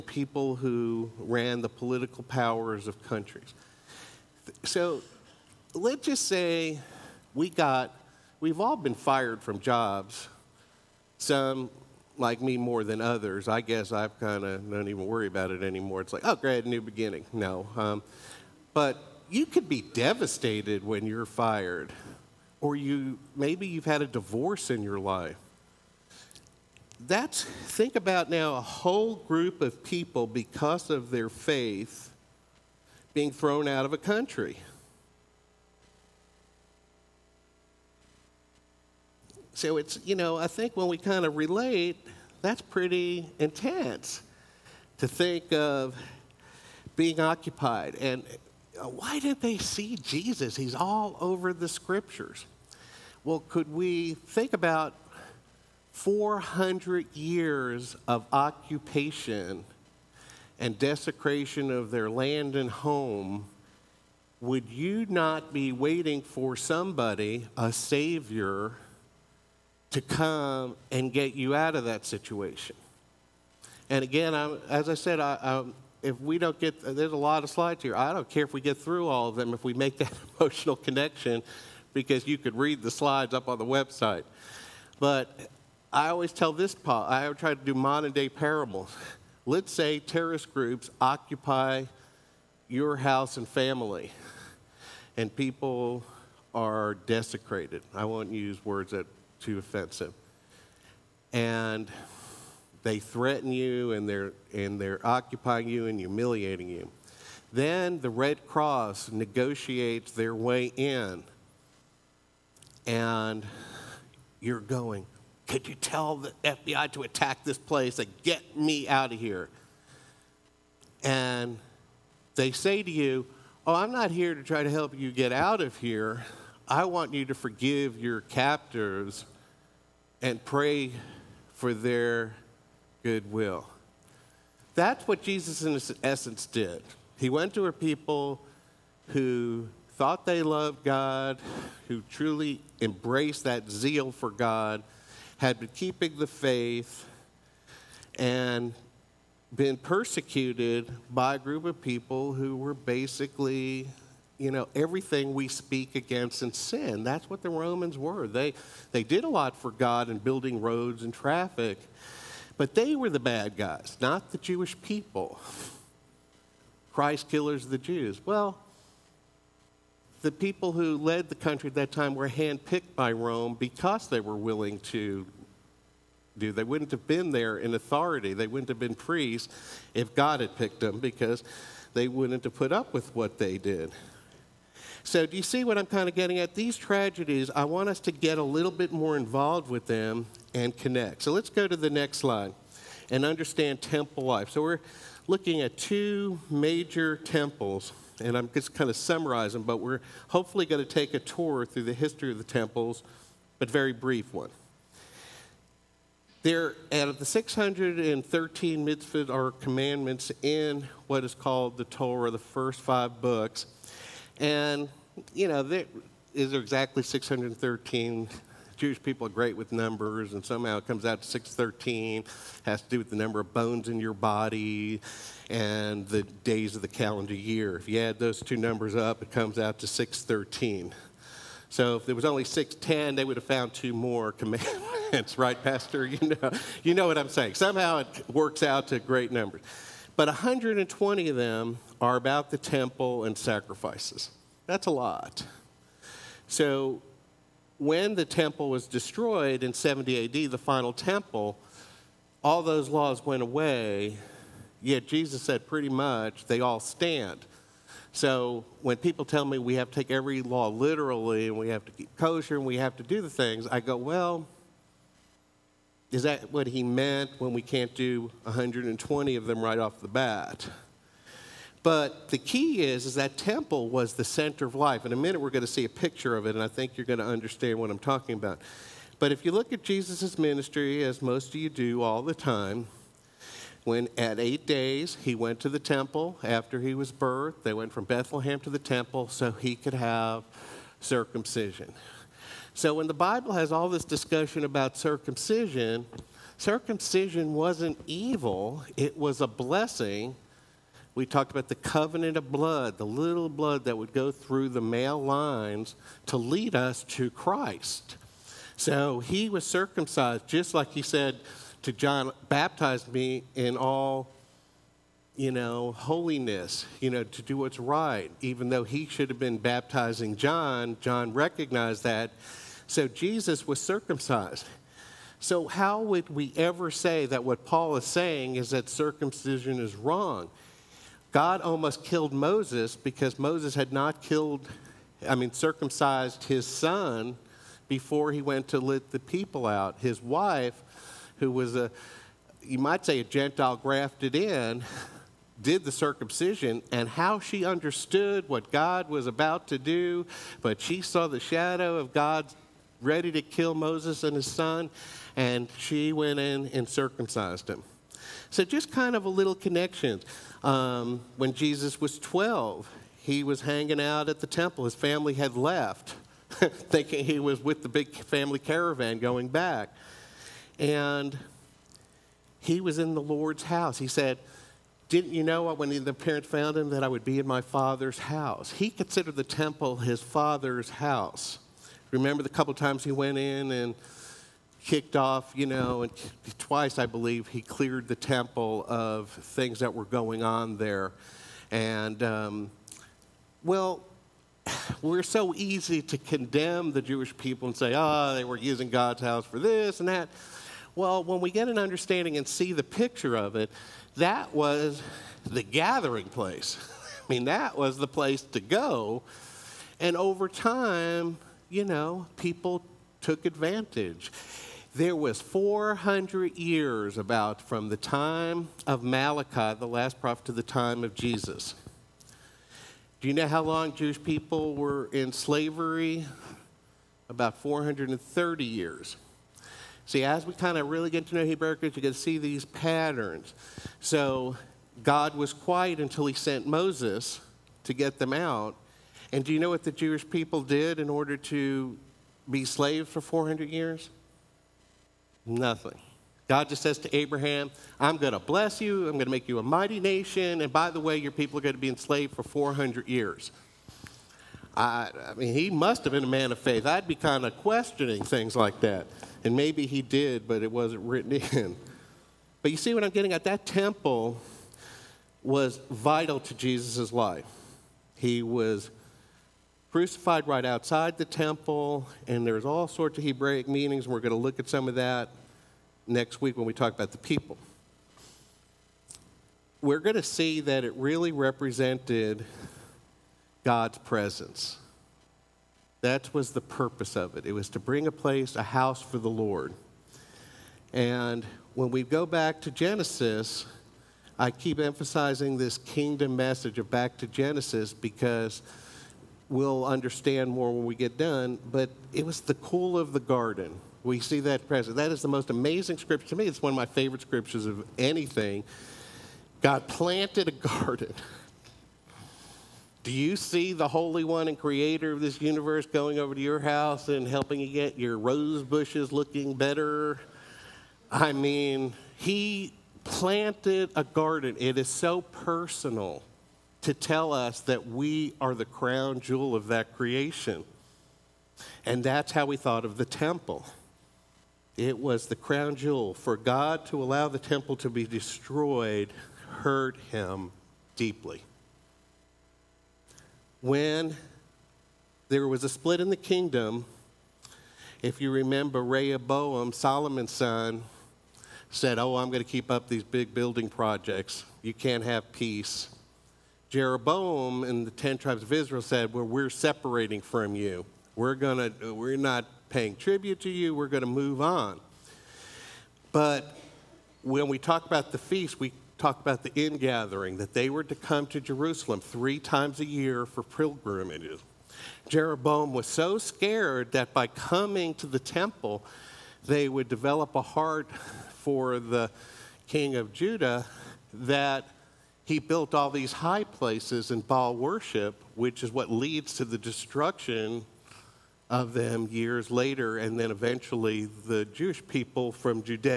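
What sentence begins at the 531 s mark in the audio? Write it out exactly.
And that's how we thought of the temple.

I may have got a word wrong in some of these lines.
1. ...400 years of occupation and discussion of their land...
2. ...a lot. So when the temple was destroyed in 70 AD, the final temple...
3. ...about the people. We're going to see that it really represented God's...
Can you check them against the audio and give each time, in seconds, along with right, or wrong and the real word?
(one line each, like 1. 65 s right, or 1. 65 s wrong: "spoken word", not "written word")
1. 56 s wrong: "desecration", not "discussion"
2. 244 s right
3. 476 s right.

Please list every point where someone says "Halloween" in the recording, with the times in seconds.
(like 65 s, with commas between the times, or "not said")
not said.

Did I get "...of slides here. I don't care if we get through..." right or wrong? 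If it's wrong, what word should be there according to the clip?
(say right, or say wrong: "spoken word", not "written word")
right.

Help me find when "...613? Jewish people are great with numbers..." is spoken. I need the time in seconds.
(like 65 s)
217 s.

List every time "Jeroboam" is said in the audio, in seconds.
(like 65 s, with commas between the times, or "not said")
556 s, 575 s.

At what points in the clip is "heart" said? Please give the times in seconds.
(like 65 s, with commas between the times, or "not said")
580 s.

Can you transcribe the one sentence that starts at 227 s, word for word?
If you add those two numbers up, it comes out to 613.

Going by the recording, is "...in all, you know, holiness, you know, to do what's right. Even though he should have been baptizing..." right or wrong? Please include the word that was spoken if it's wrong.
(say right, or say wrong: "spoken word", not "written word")
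right.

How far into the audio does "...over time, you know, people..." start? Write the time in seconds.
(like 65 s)
410 s.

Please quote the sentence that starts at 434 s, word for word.
So God was quiet until he sent Moses to get them out.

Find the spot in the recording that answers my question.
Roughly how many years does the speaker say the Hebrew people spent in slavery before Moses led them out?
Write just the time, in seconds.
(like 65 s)
427 s.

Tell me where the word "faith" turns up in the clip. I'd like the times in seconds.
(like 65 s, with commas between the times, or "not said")
31 s, 146 s, 456 s.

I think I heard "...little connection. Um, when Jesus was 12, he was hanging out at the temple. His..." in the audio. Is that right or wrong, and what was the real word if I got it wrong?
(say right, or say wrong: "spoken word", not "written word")
right.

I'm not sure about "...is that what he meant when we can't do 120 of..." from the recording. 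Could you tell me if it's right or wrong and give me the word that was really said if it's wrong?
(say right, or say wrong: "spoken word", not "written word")
right.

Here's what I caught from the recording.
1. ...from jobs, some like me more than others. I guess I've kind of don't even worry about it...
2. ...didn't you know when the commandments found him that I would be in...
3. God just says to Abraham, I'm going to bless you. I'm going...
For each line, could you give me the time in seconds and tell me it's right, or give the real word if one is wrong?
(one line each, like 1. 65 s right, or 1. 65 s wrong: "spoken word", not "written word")
1. 9 s right
2. 375 s wrong: "parents", not "commandments"
3. 446 s right.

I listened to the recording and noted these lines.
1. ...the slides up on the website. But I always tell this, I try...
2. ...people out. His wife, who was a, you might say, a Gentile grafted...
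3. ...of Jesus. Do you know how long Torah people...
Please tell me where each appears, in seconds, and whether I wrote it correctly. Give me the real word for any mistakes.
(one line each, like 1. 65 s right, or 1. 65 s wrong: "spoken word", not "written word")
1. 82 s right
2. 339 s right
3. 421 s wrong: "Jewish", not "Torah".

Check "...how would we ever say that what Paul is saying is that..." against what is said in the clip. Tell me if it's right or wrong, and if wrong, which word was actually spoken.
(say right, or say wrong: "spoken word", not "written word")
right.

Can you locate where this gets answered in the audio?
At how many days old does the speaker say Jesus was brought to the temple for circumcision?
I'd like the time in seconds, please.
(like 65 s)
284 s.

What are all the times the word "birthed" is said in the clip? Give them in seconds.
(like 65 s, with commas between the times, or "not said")
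287 s.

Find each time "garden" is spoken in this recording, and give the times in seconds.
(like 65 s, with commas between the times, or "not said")
503 s, 510 s, 524 s.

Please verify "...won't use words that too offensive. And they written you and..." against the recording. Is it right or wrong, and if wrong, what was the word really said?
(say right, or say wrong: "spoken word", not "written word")
wrong: "threaten", not "written".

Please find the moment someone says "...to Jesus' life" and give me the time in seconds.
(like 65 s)
466 s.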